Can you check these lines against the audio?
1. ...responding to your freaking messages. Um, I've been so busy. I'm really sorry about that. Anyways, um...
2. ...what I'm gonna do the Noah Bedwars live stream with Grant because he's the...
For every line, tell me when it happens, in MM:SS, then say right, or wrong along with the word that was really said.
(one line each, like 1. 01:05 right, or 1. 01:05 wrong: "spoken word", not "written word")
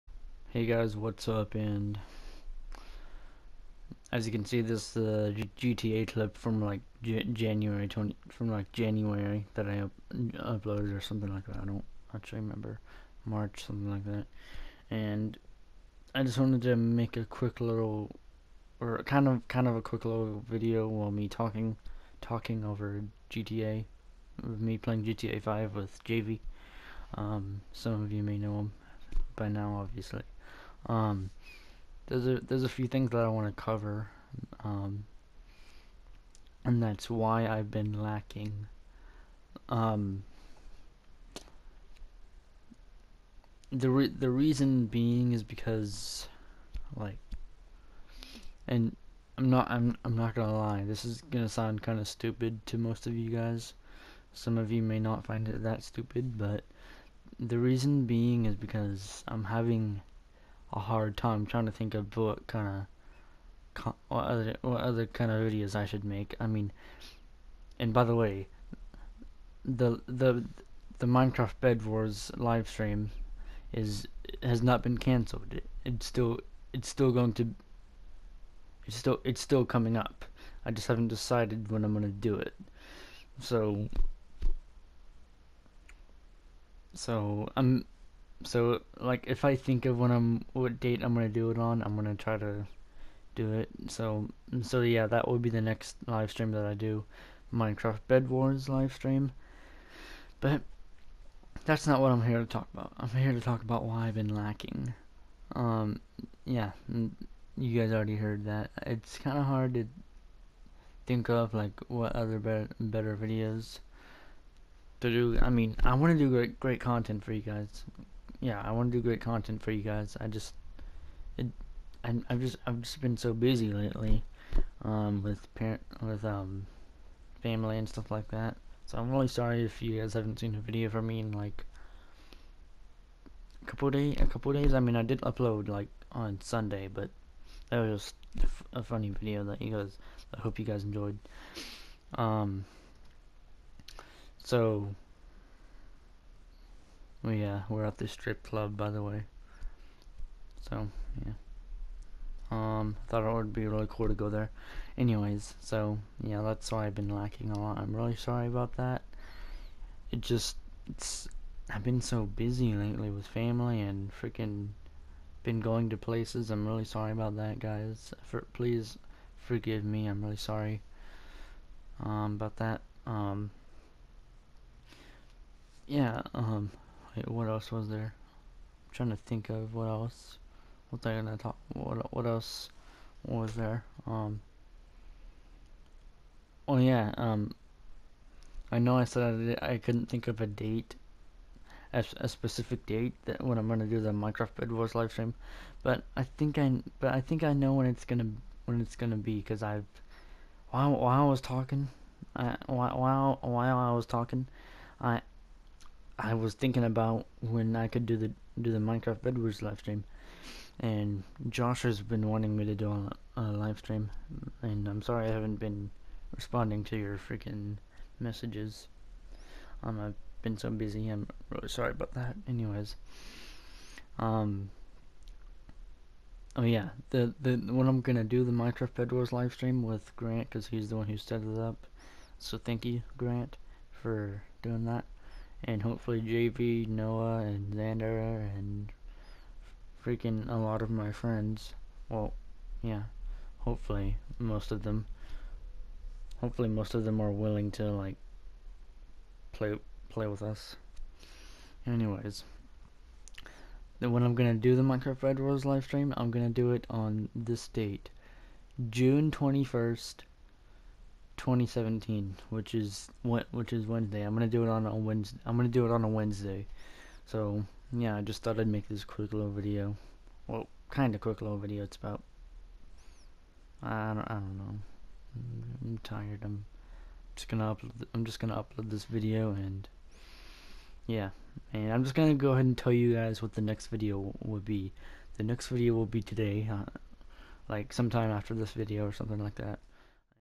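1. 03:36 right
2. 03:47 wrong: "Minecraft", not "Noah".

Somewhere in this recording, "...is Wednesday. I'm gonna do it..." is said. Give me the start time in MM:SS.
04:23.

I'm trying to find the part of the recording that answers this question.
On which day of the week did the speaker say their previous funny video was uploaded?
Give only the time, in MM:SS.
02:16.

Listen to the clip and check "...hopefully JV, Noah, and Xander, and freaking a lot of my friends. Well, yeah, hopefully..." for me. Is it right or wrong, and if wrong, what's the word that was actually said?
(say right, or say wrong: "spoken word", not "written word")
right.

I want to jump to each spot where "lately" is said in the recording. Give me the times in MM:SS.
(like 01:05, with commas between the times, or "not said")
02:03, 02:42.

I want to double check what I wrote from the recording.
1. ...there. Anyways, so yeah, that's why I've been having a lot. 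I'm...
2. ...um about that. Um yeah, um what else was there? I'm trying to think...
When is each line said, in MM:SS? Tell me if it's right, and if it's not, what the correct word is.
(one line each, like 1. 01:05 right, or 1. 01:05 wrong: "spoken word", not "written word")
1. 02:34 wrong: "lacking", not "having"
2. 02:52 right.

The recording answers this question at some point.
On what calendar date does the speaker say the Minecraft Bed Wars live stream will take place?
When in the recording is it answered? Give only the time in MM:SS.
04:18.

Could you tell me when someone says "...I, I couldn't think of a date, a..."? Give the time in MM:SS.
03:09.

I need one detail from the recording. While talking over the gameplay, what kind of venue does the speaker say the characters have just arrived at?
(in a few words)
Strip club.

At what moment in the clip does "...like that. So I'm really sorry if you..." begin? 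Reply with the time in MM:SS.
02:08.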